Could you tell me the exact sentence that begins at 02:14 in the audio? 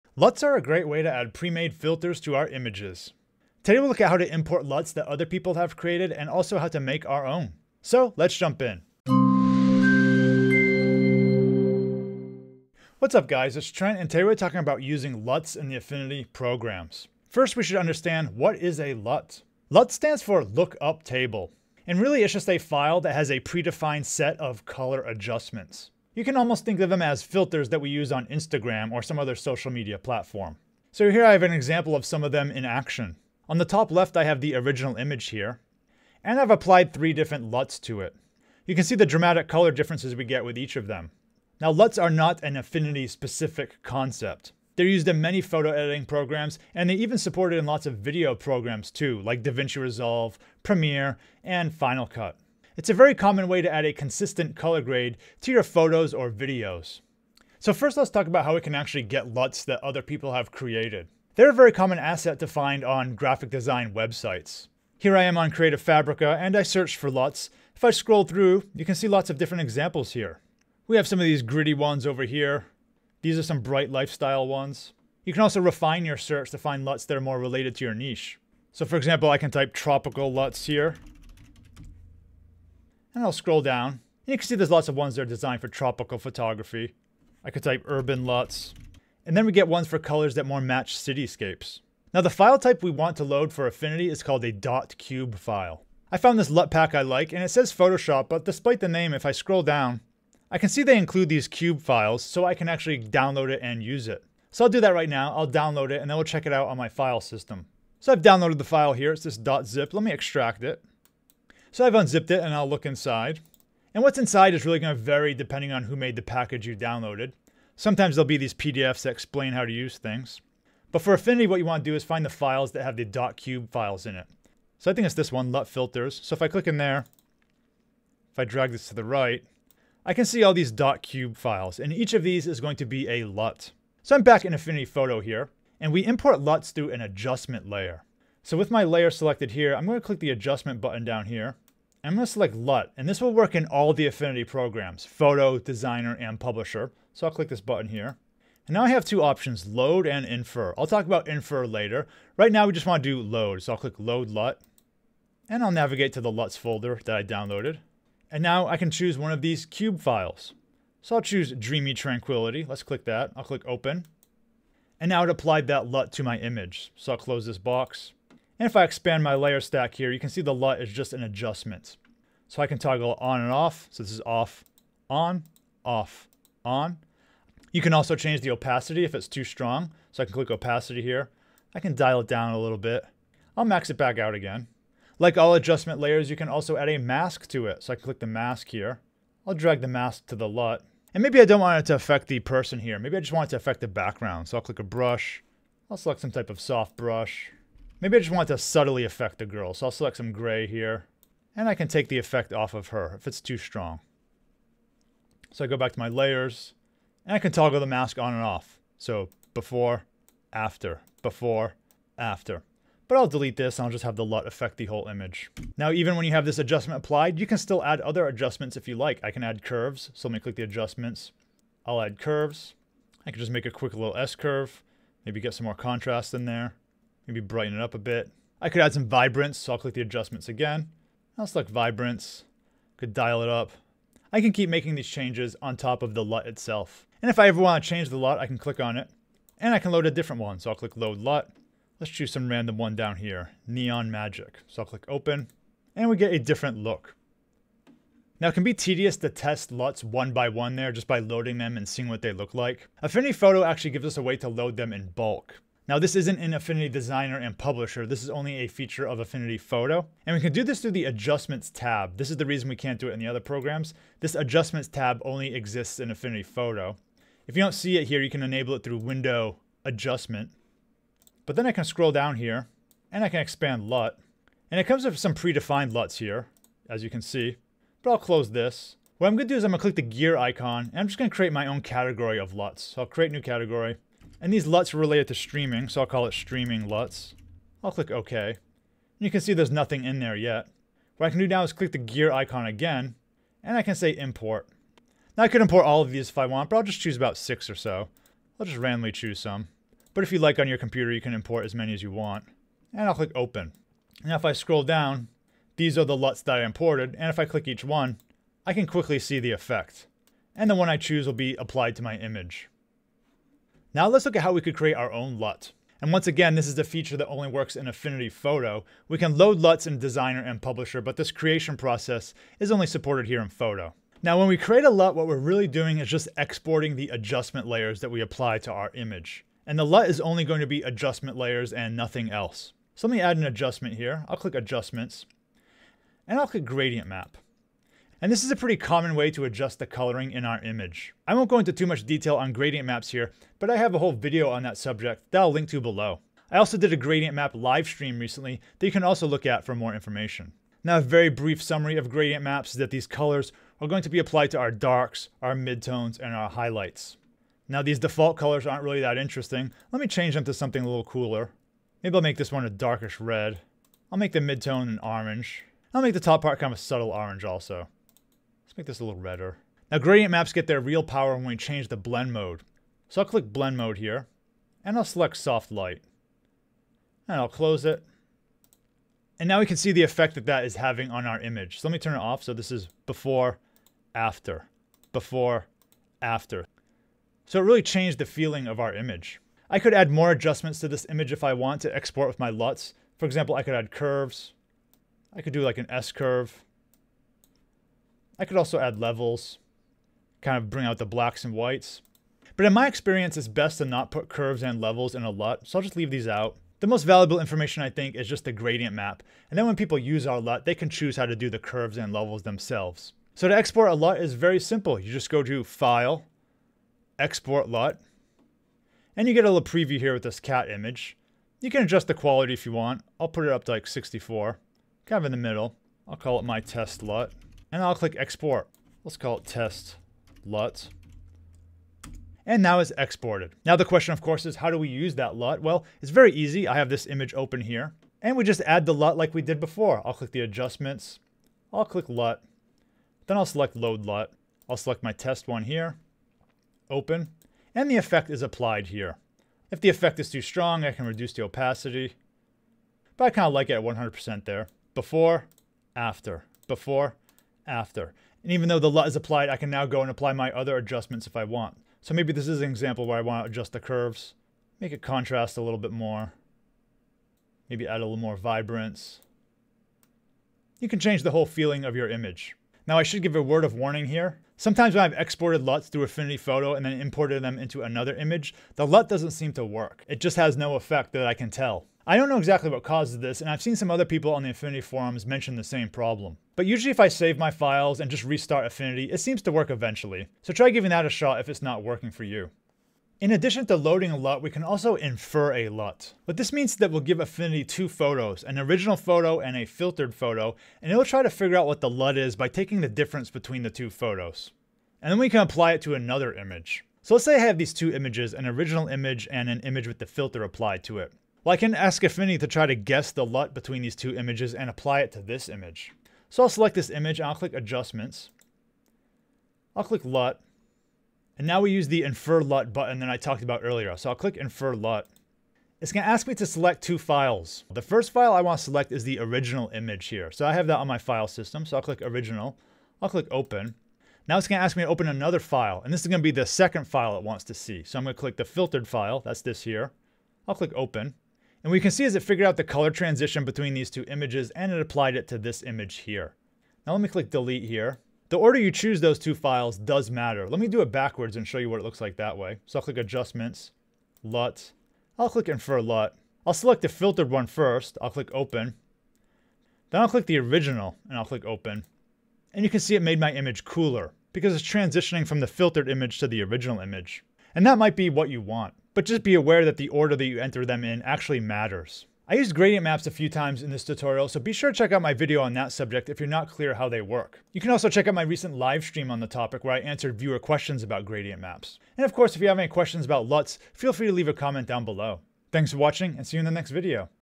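So I'm back in Affinity Photo here, and we import LUTs through an adjustment layer.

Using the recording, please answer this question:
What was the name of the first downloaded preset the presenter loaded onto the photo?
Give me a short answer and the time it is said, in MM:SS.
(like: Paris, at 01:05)
Dreamy Tranquility, at 02:41.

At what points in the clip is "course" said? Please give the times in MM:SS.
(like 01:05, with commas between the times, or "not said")
07:14, 09:42.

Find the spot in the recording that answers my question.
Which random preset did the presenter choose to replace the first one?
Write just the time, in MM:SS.
04:03.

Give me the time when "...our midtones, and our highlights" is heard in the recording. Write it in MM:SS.
05:55.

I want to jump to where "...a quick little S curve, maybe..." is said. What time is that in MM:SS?
03:43.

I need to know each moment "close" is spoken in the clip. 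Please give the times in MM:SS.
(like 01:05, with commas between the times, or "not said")
02:47, 04:38, 06:17.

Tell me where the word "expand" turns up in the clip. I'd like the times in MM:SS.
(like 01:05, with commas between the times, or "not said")
02:48, 04:33.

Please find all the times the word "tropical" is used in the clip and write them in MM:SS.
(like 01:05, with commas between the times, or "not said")
01:19, 01:25.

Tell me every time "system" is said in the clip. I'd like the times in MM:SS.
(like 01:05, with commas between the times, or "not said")
01:47, 08:51.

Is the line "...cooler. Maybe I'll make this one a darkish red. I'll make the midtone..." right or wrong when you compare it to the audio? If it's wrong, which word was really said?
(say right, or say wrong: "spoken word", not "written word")
right.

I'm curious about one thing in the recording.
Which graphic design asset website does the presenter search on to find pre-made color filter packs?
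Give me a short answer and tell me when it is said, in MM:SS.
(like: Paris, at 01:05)
Creative Fabrica, at 01:05.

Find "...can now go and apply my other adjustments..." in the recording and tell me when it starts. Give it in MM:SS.
07:39.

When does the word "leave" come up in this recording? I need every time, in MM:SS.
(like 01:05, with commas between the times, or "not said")
06:45, 09:44.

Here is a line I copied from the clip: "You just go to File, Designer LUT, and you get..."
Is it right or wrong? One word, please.
wrong.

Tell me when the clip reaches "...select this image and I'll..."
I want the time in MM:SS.
08:36.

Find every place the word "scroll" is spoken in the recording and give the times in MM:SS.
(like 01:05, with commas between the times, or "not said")
01:07, 01:23, 01:39, 04:31, 05:04.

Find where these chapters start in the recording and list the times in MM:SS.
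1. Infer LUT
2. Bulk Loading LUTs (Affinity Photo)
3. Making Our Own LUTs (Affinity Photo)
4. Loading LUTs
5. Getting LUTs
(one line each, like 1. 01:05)
1. 08:12
2. 04:07
3. 05:13
4. 01:48
5. 00:57.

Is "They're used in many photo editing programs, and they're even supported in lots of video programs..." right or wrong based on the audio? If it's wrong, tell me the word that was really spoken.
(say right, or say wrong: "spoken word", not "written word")
right.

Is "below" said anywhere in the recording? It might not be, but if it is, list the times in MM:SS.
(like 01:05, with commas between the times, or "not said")
05:45, 09:44.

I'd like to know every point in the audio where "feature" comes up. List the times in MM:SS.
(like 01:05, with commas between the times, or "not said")
04:18, 05:16.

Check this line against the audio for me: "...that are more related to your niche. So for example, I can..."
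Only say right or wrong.
right.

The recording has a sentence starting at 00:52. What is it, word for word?
It's a very common way to add a consistent color grade to your photos or videos.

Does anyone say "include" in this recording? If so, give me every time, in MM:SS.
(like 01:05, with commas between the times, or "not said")
01:40.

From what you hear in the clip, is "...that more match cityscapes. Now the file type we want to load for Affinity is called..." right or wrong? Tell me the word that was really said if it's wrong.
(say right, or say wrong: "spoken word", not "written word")
right.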